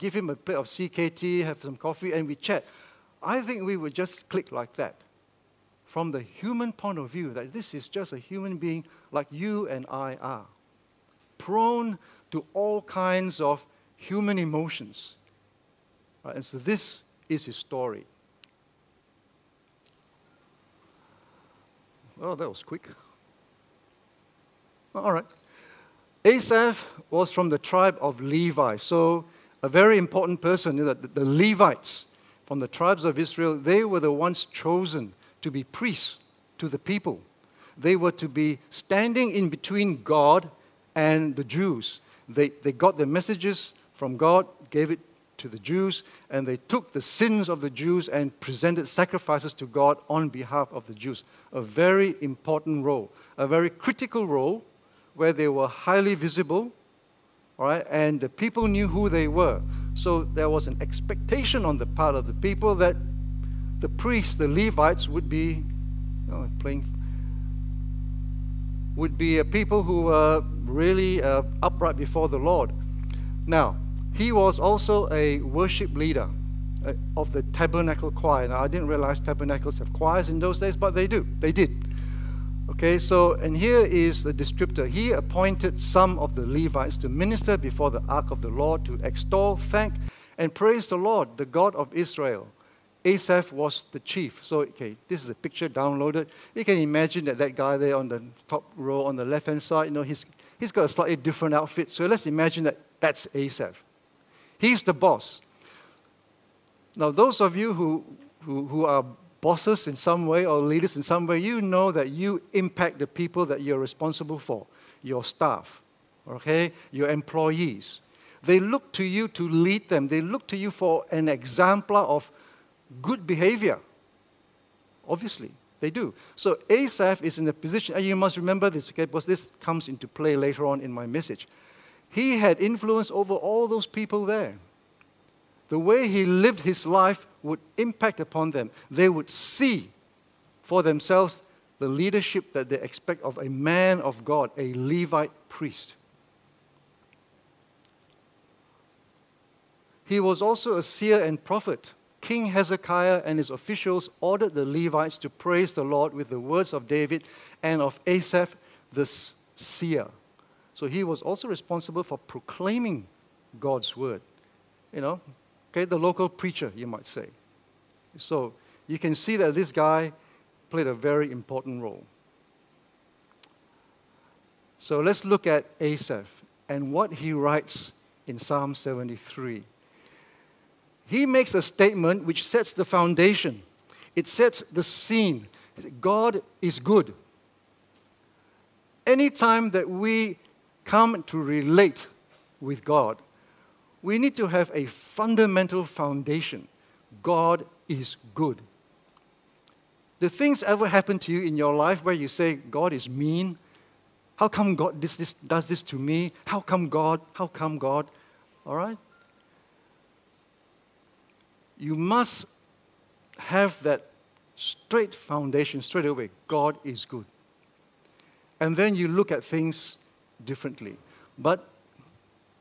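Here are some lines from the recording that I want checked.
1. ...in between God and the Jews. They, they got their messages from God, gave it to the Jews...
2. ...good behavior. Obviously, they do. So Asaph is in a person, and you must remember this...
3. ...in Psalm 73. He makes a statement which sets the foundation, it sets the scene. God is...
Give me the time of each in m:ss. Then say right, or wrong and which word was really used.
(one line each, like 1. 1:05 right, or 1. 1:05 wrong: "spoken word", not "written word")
1. 0:39 right
2. 2:03 wrong: "position", not "person"
3. 2:58 right.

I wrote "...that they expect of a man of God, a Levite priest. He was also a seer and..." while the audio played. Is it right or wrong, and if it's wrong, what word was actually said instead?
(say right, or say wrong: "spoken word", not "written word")
right.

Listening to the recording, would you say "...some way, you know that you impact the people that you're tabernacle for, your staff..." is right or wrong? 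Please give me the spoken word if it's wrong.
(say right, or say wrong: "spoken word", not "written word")
wrong: "responsible", not "tabernacle".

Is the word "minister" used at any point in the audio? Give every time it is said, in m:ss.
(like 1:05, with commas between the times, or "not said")
1:27.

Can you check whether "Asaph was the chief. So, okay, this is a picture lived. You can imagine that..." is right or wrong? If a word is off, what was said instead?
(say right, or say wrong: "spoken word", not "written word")
wrong: "downloaded", not "lived".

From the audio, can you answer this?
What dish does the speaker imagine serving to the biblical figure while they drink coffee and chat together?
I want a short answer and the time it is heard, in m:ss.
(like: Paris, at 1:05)
CKT, at 0:00.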